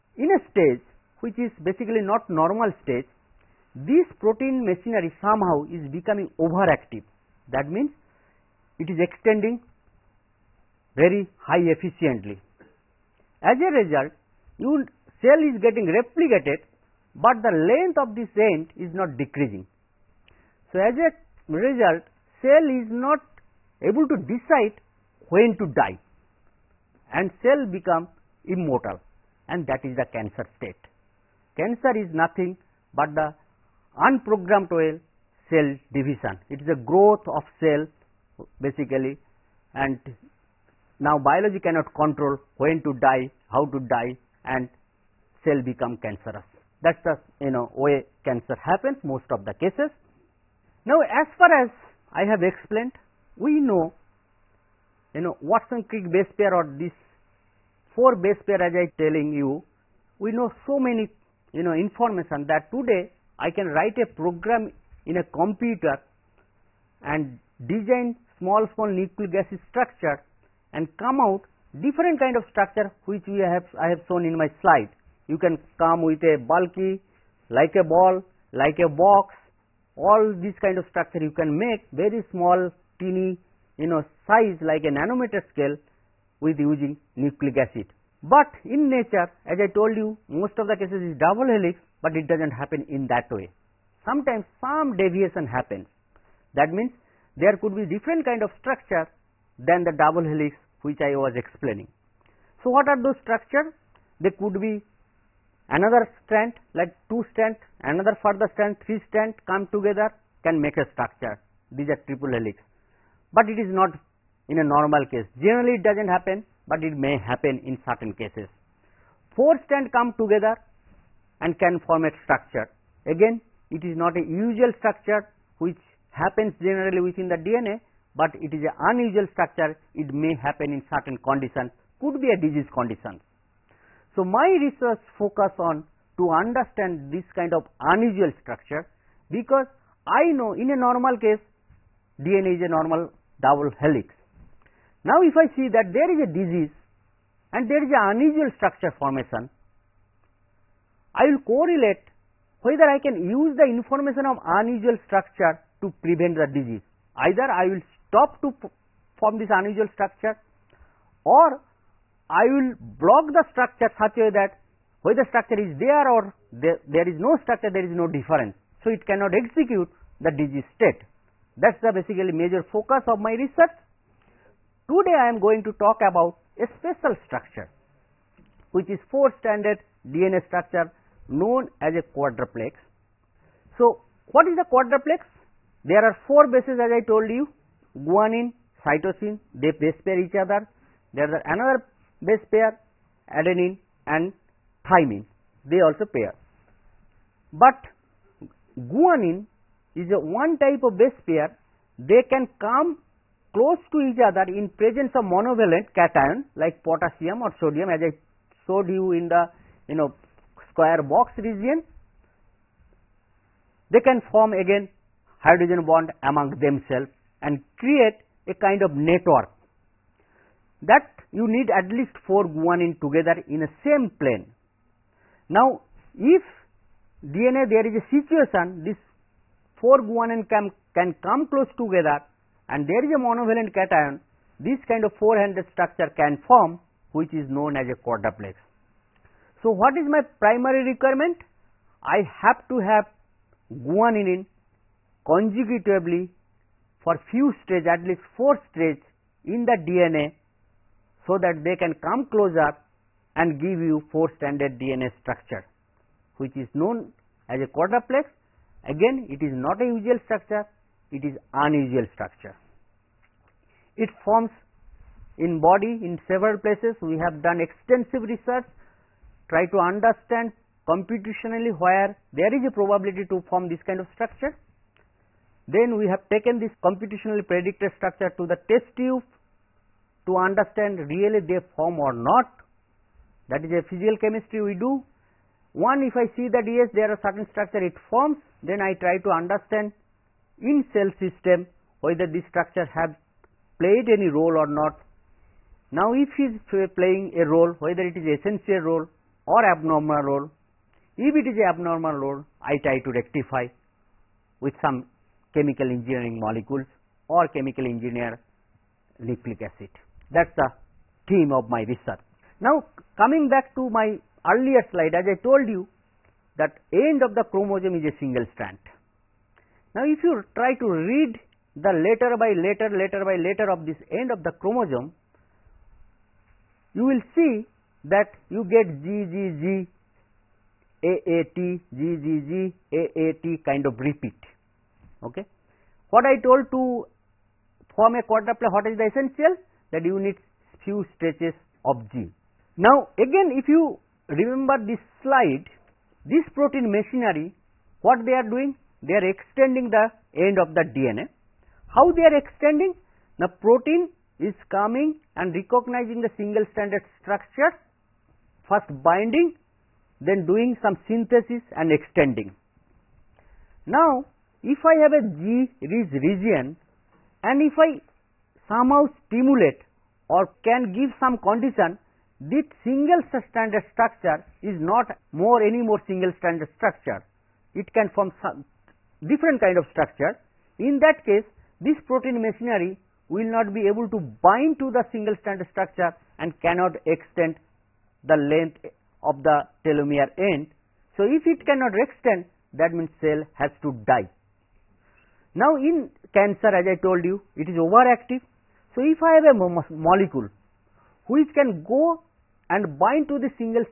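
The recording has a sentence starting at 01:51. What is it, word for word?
These are triple helix, but it is not in a normal case.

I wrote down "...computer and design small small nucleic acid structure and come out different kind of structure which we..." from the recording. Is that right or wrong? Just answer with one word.
right.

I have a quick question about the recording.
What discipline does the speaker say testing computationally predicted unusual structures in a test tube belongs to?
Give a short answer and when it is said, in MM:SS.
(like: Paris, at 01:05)
Physical chemistry, at 04:43.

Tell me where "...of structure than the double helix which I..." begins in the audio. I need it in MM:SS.
01:38.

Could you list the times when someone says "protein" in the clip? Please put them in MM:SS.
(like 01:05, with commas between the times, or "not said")
00:04, 05:46, 05:53, 06:22.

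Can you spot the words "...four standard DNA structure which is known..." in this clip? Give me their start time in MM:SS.
04:14.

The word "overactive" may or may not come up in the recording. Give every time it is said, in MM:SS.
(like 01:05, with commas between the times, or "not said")
00:06, 06:37.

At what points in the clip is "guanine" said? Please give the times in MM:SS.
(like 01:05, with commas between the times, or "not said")
03:08, 03:18, 03:42, 03:50, 04:03.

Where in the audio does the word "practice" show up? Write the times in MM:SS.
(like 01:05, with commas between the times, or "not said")
not said.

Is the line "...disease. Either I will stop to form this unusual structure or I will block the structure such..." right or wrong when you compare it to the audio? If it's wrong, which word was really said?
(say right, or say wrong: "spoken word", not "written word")
right.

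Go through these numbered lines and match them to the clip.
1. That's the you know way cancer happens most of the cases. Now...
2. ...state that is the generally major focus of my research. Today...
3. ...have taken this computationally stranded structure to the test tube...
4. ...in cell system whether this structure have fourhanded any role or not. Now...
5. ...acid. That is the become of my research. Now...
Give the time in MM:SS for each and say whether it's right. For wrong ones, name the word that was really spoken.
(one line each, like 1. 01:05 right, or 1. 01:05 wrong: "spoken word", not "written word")
1. 00:46 right
2. 02:50 wrong: "basically", not "generally"
3. 04:36 wrong: "predicted", not "stranded"
4. 04:50 wrong: "played", not "fourhanded"
5. 05:09 wrong: "theme", not "become".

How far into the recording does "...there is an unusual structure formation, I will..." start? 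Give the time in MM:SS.
02:27.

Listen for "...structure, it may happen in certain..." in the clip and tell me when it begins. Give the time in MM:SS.
02:09.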